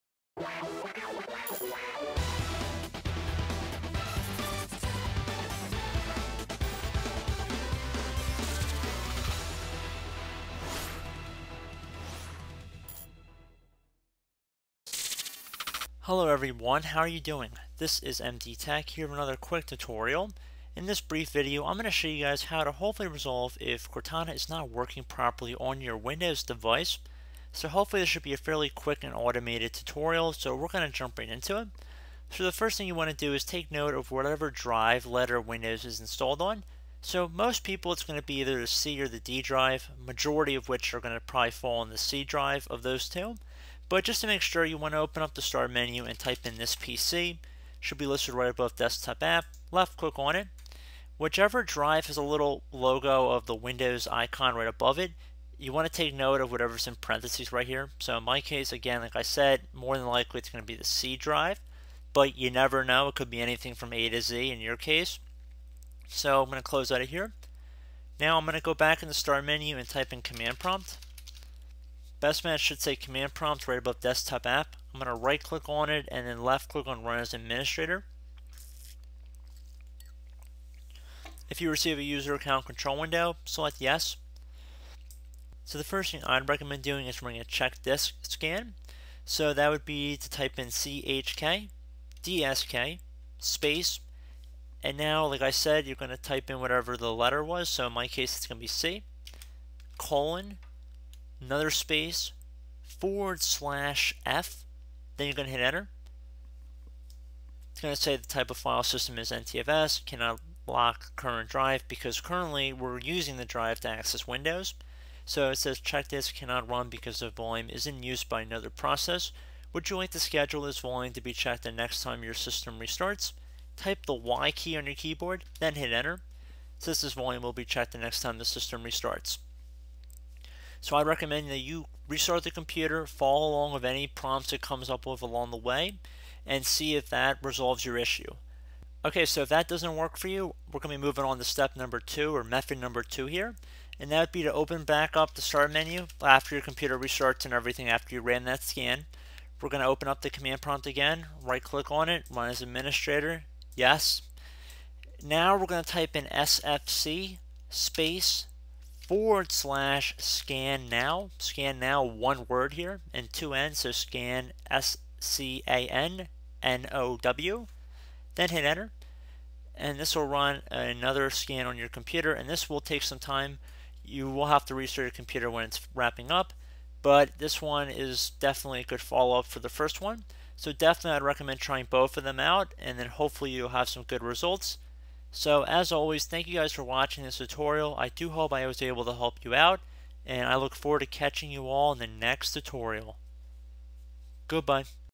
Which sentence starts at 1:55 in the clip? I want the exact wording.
So it says check disk cannot run because the volume is in use by another process.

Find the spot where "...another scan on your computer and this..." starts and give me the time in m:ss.
2:50.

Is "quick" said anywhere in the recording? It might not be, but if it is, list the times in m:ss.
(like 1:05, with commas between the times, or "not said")
0:19, 0:28.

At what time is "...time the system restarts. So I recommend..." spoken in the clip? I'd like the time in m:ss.
2:08.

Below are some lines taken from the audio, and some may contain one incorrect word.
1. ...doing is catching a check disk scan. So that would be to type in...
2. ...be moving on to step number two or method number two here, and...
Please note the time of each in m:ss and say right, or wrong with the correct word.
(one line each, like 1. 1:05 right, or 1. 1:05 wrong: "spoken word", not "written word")
1. 1:26 wrong: "running", not "catching"
2. 2:20 right.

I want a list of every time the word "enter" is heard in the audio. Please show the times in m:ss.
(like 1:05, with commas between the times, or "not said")
1:45, 2:05, 2:48.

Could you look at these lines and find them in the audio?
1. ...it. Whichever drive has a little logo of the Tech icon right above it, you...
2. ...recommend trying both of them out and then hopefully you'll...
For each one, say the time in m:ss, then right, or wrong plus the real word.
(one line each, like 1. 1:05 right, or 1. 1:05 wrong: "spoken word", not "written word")
1. 0:50 wrong: "Windows", not "Tech"
2. 3:01 right.